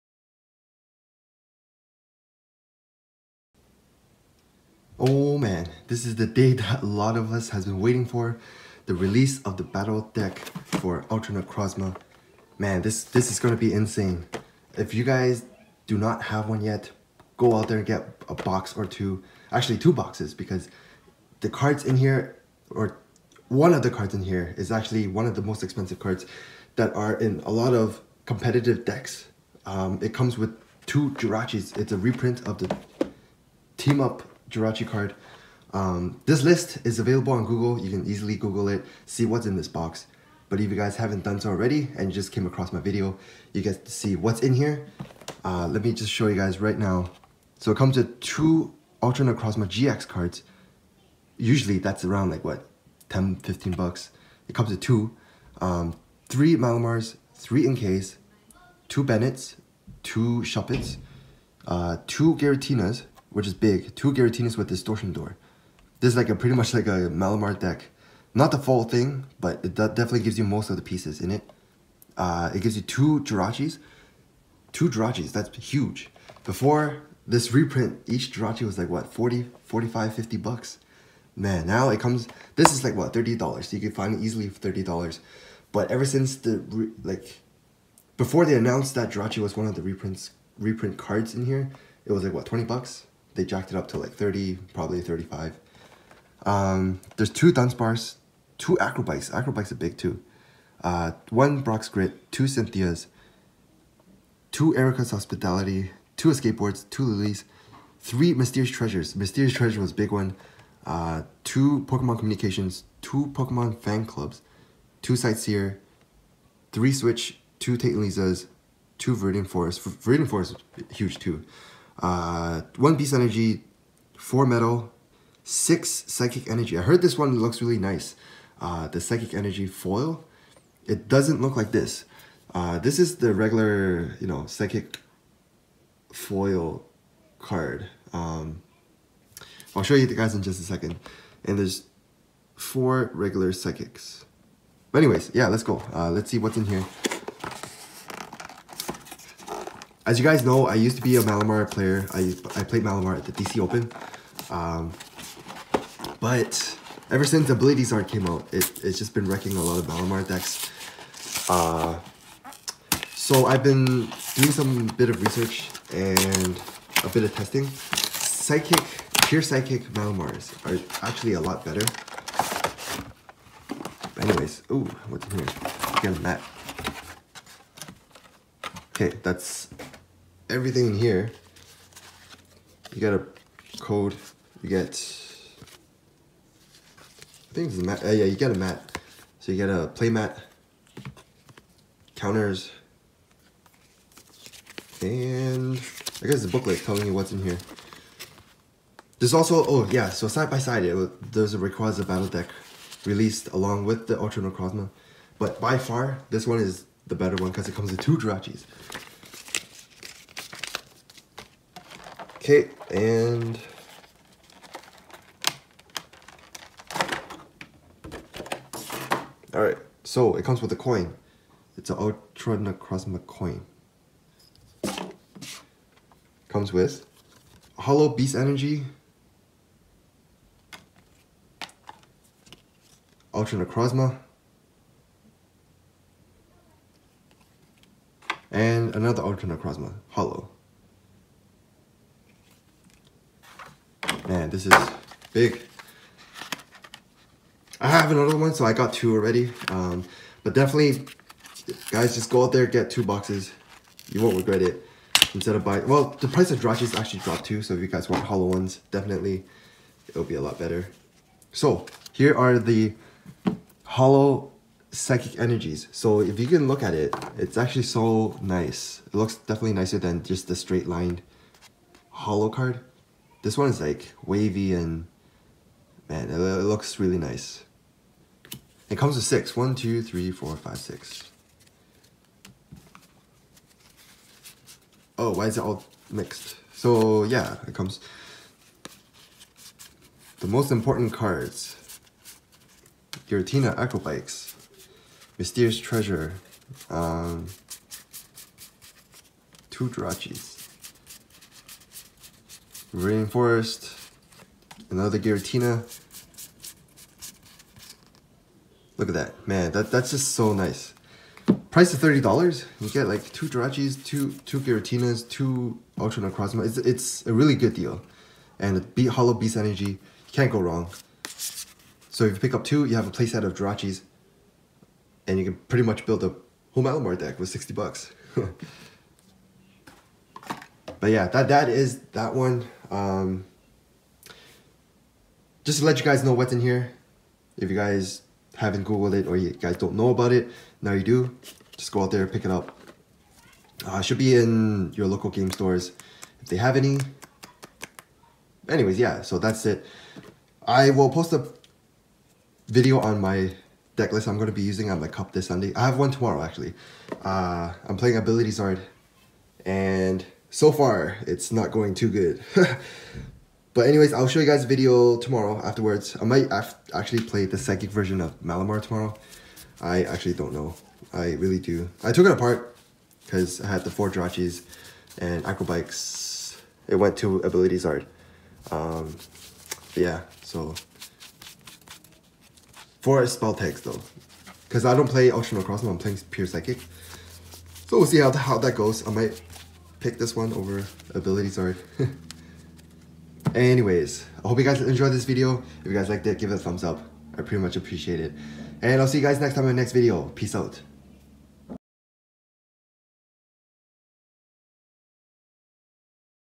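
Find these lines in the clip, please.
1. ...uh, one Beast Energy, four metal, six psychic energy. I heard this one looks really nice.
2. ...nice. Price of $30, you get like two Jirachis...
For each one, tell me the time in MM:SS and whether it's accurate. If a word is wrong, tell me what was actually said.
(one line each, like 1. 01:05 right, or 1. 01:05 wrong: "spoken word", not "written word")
1. 02:02 right
2. 05:10 right.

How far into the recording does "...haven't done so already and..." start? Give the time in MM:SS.
00:40.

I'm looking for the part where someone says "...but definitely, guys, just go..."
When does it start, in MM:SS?
04:10.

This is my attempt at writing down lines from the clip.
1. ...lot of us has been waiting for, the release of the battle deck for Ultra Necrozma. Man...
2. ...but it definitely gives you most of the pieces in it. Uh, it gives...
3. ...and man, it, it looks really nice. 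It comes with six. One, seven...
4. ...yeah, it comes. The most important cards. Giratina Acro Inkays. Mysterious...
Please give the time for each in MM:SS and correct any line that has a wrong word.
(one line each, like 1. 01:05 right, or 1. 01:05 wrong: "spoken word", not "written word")
1. 00:06 right
2. 01:09 right
3. 04:34 wrong: "two", not "seven"
4. 04:47 wrong: "Bikes", not "Inkays".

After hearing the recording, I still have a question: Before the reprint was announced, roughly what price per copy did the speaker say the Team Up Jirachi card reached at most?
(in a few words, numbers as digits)
$50.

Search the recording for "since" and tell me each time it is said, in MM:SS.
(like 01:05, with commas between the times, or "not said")
01:26, 02:37.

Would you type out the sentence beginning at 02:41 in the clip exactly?
Uh, so I've been doing some bit of research and a bit of testing.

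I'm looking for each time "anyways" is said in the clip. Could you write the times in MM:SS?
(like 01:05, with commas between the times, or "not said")
02:24, 02:54, 05:48, 06:03, 06:33.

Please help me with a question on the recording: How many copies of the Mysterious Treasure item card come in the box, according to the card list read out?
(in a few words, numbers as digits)
3.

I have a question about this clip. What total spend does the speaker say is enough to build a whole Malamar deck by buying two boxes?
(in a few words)
$60.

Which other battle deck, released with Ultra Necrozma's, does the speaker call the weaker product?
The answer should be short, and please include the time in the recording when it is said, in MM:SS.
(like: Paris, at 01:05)
Rayquaza, at 03:21.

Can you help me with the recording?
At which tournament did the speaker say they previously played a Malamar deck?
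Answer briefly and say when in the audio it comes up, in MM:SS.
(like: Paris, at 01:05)
DC Open, at 02:33.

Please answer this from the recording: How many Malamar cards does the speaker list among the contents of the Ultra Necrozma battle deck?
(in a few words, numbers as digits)
3.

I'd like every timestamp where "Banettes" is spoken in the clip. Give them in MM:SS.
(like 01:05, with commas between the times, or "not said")
00:59.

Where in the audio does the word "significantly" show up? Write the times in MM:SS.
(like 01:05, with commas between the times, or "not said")
not said.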